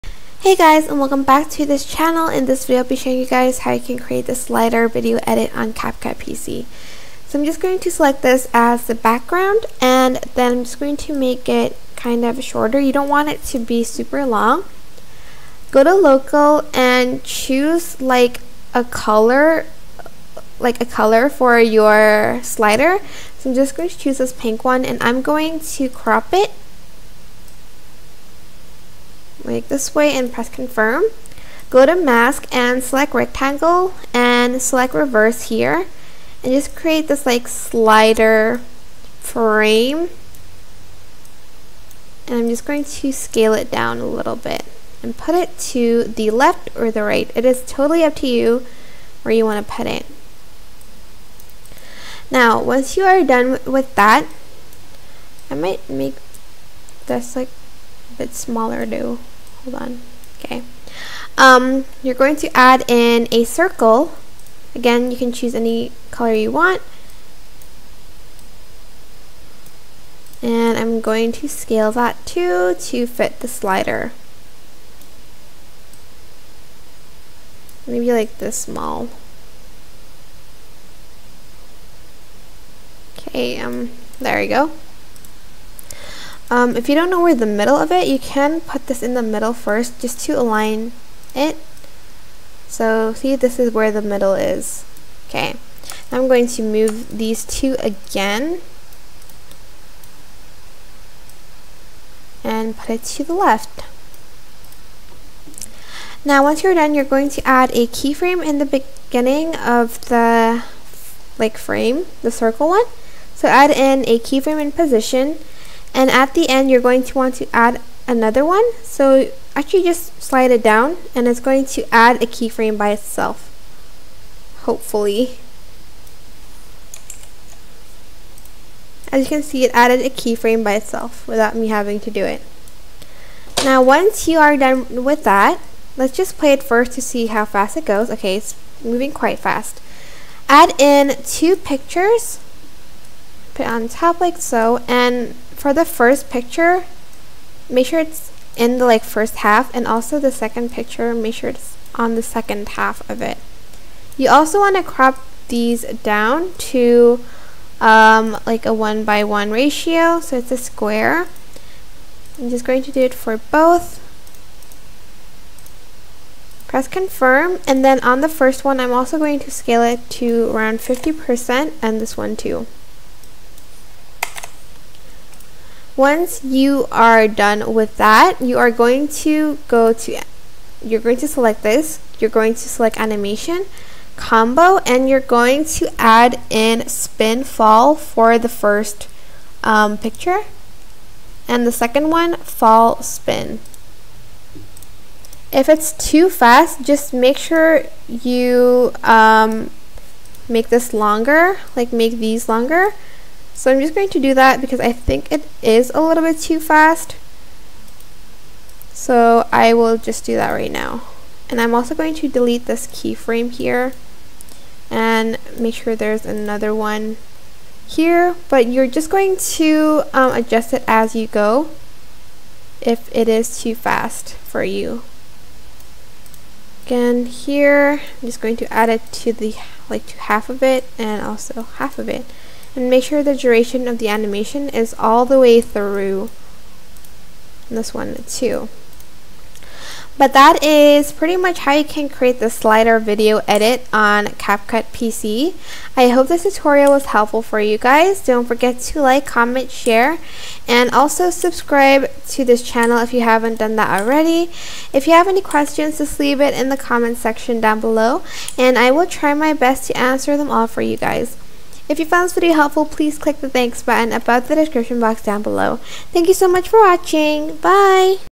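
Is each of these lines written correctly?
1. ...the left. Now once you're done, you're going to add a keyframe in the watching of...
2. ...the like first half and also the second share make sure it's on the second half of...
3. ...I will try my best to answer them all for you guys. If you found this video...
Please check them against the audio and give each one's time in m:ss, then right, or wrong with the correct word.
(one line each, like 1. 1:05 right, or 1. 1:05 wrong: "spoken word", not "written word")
1. 1:43 wrong: "beginning", not "watching"
2. 2:28 wrong: "picture", not "share"
3. 4:18 right.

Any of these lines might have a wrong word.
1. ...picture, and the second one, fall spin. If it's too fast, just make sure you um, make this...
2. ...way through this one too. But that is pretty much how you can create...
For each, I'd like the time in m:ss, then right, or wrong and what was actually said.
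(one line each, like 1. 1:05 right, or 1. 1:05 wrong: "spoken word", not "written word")
1. 3:09 right
2. 3:55 right.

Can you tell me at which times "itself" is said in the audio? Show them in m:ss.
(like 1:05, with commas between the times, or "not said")
2:02, 2:10.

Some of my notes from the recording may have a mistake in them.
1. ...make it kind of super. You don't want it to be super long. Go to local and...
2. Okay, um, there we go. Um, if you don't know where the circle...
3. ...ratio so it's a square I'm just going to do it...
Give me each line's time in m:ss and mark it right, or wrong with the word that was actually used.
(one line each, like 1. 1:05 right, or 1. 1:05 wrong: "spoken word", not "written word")
1. 0:11 wrong: "shorter", not "super"
2. 1:23 wrong: "middle", not "circle"
3. 2:39 right.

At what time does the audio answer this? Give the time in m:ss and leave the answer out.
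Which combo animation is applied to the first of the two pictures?
3:06.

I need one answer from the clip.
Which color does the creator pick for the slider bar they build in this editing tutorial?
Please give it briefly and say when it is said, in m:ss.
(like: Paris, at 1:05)
pink, at 0:24.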